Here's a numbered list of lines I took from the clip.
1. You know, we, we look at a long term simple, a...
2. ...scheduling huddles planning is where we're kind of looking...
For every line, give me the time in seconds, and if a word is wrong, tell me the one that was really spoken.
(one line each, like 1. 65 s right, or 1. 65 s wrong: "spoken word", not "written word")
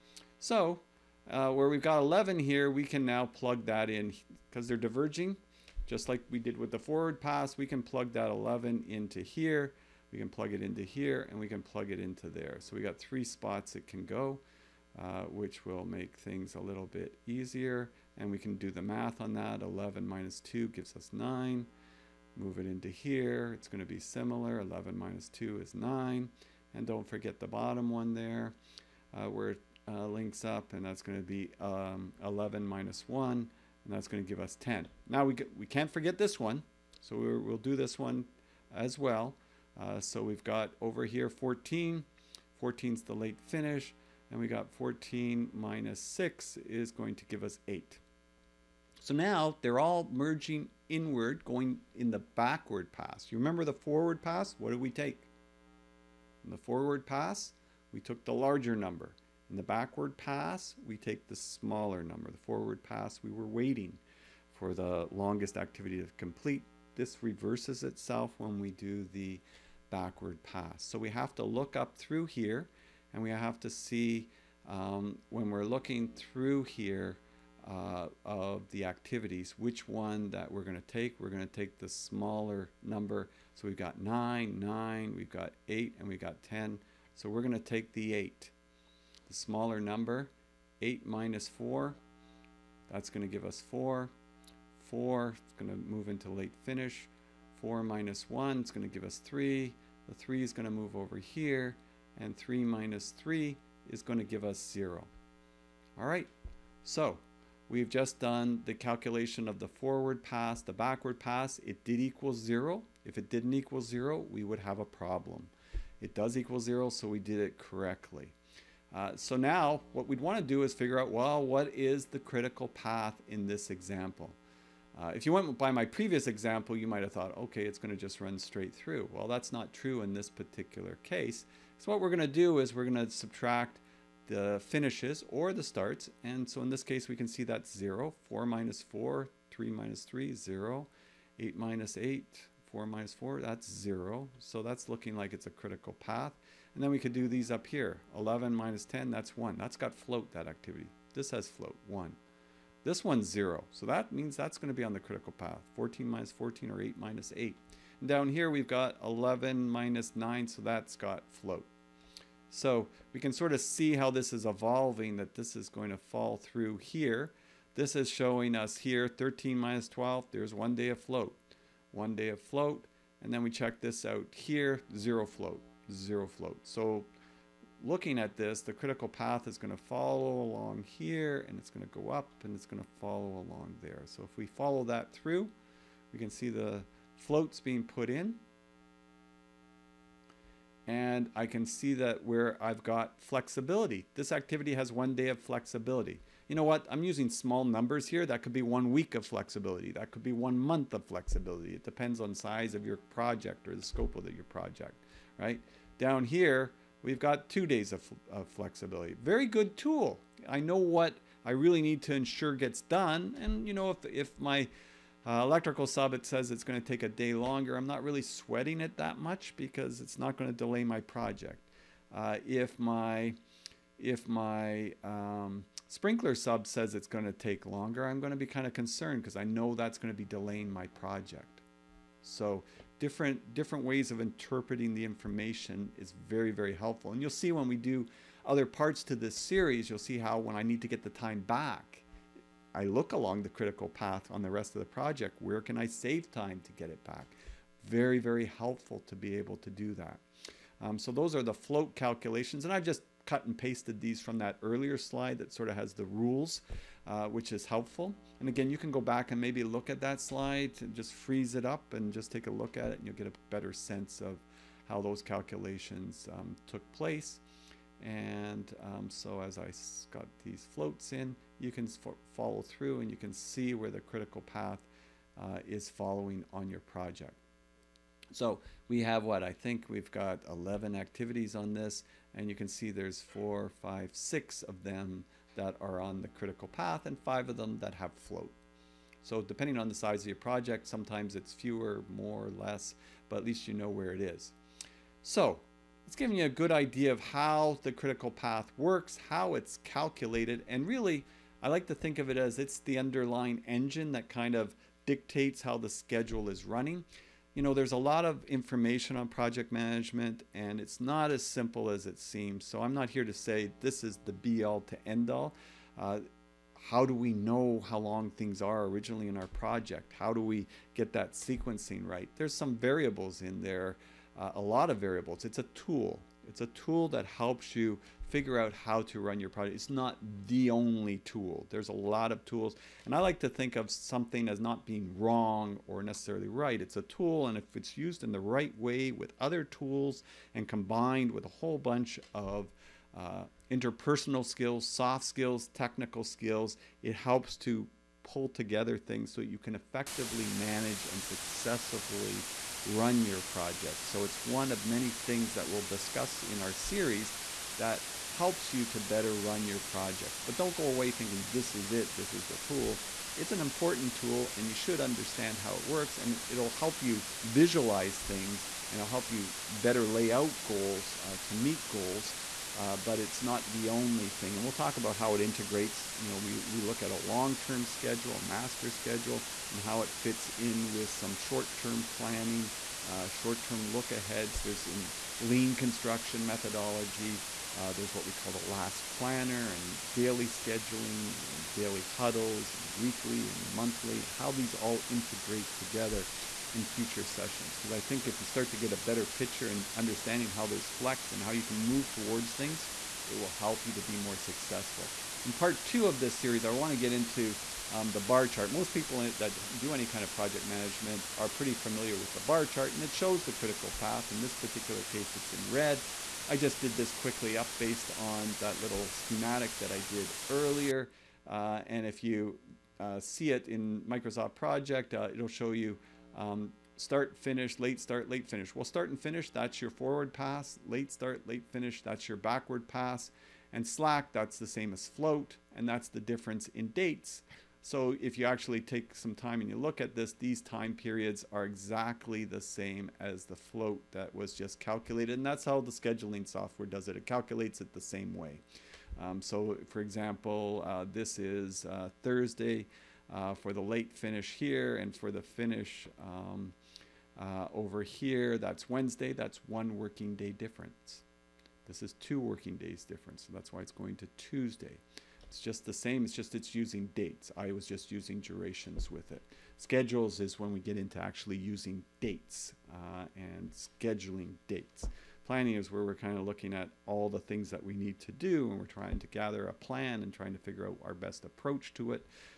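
1. 376 s wrong: "schedule", not "simple"
2. 473 s wrong: "dates", not "huddles".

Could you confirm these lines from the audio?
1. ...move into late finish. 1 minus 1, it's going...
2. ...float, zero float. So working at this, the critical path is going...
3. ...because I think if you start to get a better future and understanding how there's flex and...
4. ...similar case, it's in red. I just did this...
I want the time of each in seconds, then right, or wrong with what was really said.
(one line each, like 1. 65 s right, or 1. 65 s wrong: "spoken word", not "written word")
1. 95 s wrong: "4", not "1"
2. 175 s wrong: "looking", not "working"
3. 397 s wrong: "picture", not "future"
4. 414 s wrong: "particular", not "similar".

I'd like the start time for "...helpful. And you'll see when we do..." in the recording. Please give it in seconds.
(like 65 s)
236 s.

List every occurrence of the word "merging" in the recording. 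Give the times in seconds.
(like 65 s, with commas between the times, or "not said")
50 s.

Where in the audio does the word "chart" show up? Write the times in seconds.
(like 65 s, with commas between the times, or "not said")
408 s, 412 s.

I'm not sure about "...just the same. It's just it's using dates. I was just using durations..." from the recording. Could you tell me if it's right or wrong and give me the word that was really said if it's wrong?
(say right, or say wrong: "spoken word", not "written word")
right.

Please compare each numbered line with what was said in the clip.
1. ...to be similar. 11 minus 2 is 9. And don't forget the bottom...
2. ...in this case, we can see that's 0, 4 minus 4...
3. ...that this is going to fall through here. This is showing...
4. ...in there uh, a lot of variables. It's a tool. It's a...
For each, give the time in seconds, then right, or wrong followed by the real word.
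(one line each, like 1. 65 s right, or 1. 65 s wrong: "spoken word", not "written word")
1. 23 s right
2. 136 s right
3. 165 s right
4. 323 s right.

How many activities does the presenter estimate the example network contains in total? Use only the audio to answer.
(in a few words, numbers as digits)
11.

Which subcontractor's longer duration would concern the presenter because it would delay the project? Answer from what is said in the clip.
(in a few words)
Sprinkler sub.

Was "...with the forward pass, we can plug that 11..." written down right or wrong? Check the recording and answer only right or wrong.
right.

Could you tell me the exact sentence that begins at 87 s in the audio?
So we're going to take the 8.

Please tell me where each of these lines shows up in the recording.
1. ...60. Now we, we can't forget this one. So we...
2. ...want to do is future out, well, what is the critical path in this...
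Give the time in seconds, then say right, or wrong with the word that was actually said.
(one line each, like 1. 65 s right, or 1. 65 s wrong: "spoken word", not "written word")
1. 34 s wrong: "10", not "60"
2. 120 s wrong: "figure", not "future".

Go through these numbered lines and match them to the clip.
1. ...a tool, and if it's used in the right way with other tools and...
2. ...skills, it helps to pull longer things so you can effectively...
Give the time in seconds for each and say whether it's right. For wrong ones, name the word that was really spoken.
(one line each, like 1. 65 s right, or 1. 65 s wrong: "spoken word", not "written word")
1. 336 s right
2. 346 s wrong: "together", not "longer".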